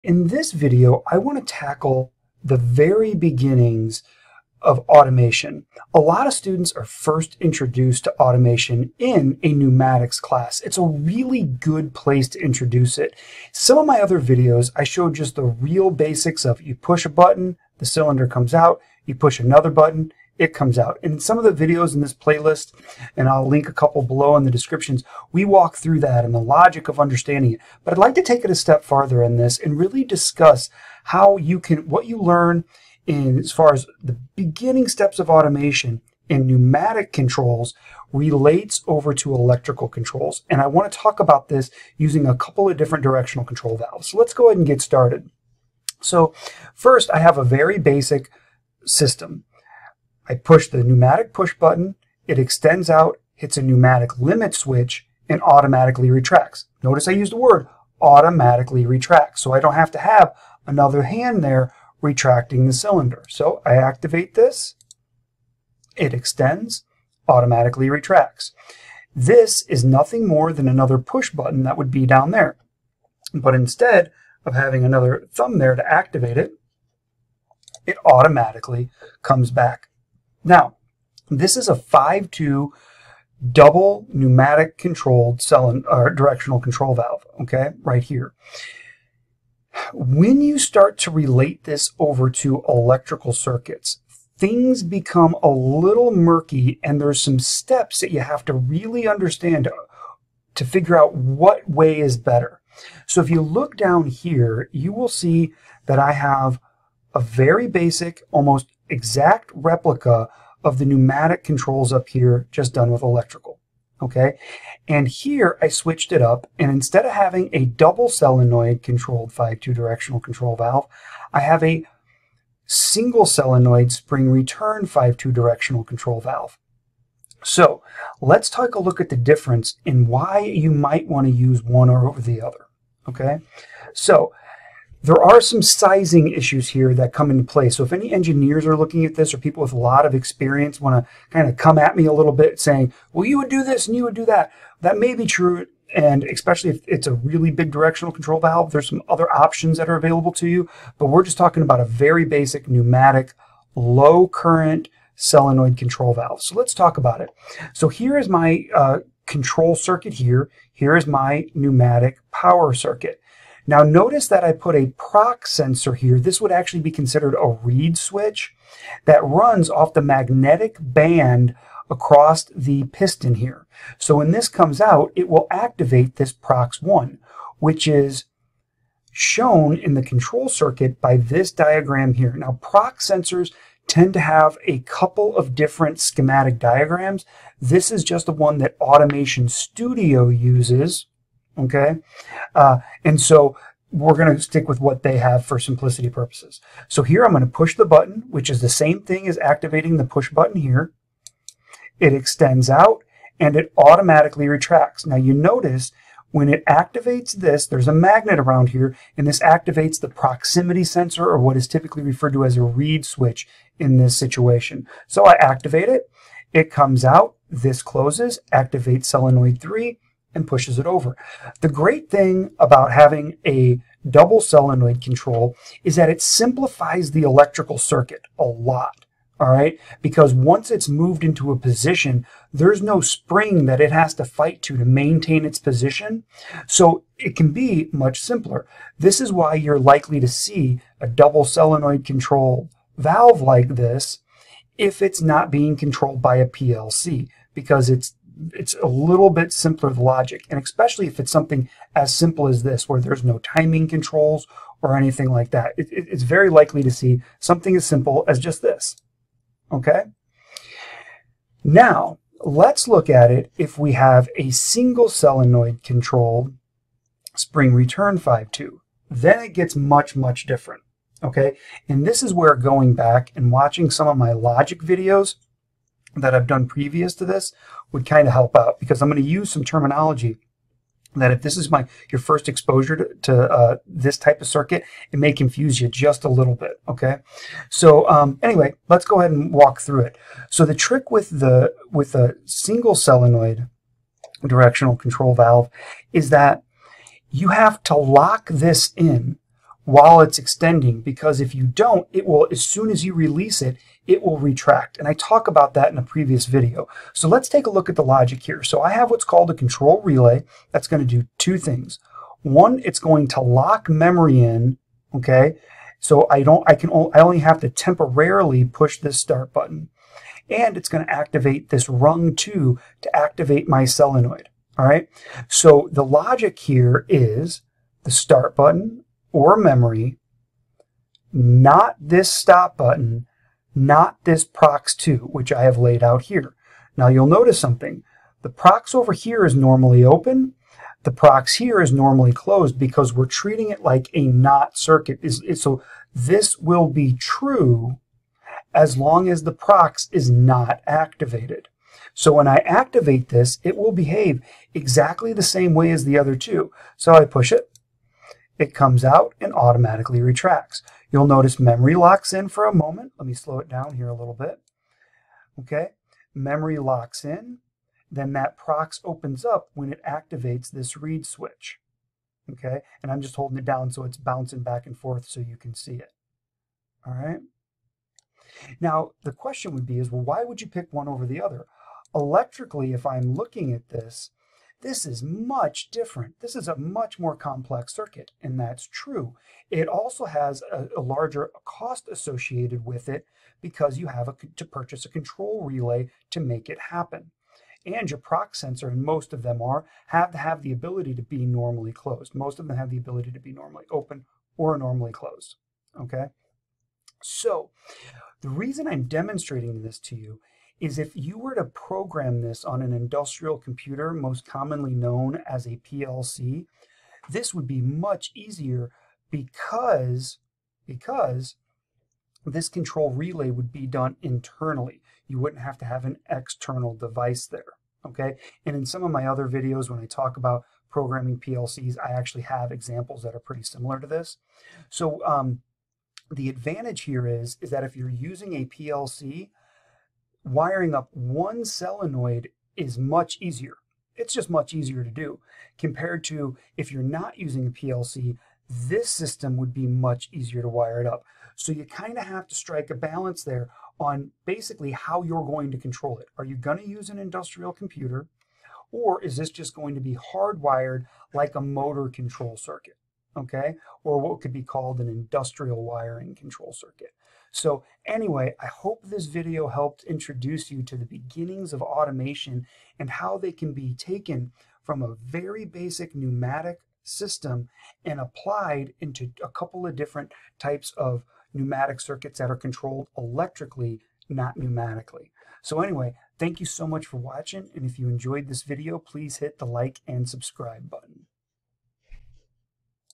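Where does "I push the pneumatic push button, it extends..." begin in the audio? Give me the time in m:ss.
0:50.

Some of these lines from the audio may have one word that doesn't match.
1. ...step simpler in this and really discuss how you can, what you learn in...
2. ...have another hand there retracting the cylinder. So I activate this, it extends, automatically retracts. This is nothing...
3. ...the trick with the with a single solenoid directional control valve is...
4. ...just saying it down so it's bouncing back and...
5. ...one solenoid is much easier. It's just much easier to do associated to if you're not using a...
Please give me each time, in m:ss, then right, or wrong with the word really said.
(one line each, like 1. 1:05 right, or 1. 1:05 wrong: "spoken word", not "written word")
1. 0:28 wrong: "farther", not "simpler"
2. 0:59 right
3. 4:50 right
4. 6:13 wrong: "holding", not "saying"
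5. 7:21 wrong: "compared", not "associated".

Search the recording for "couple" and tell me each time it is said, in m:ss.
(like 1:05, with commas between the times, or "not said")
0:23, 0:42, 3:04, 7:59.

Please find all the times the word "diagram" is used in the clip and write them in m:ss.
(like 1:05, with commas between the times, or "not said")
3:01, 3:06.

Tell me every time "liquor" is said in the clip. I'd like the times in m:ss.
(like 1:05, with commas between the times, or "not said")
not said.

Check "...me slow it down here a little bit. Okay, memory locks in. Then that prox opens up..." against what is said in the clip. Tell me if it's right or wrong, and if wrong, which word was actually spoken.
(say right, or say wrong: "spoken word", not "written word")
right.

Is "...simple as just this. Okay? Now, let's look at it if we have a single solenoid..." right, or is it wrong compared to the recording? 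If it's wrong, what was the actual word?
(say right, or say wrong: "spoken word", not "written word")
right.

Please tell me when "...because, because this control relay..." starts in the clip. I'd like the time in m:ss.
6:59.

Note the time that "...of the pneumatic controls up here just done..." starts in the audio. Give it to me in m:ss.
1:50.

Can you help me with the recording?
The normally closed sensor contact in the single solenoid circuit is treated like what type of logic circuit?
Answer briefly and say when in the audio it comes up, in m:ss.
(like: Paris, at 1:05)
Not circuit, at 5:44.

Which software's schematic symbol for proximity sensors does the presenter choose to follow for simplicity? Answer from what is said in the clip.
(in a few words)
Automation Studio.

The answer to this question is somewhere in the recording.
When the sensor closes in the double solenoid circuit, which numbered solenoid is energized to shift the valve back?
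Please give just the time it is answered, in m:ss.
3:39.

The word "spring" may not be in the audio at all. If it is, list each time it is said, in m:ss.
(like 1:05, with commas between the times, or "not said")
2:03, 3:53, 4:27.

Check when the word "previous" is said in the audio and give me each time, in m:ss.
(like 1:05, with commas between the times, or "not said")
4:36, 5:06.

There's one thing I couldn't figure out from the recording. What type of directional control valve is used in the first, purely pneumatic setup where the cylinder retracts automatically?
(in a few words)
5-2 double pneumatic.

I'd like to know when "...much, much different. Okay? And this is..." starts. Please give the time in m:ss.
4:29.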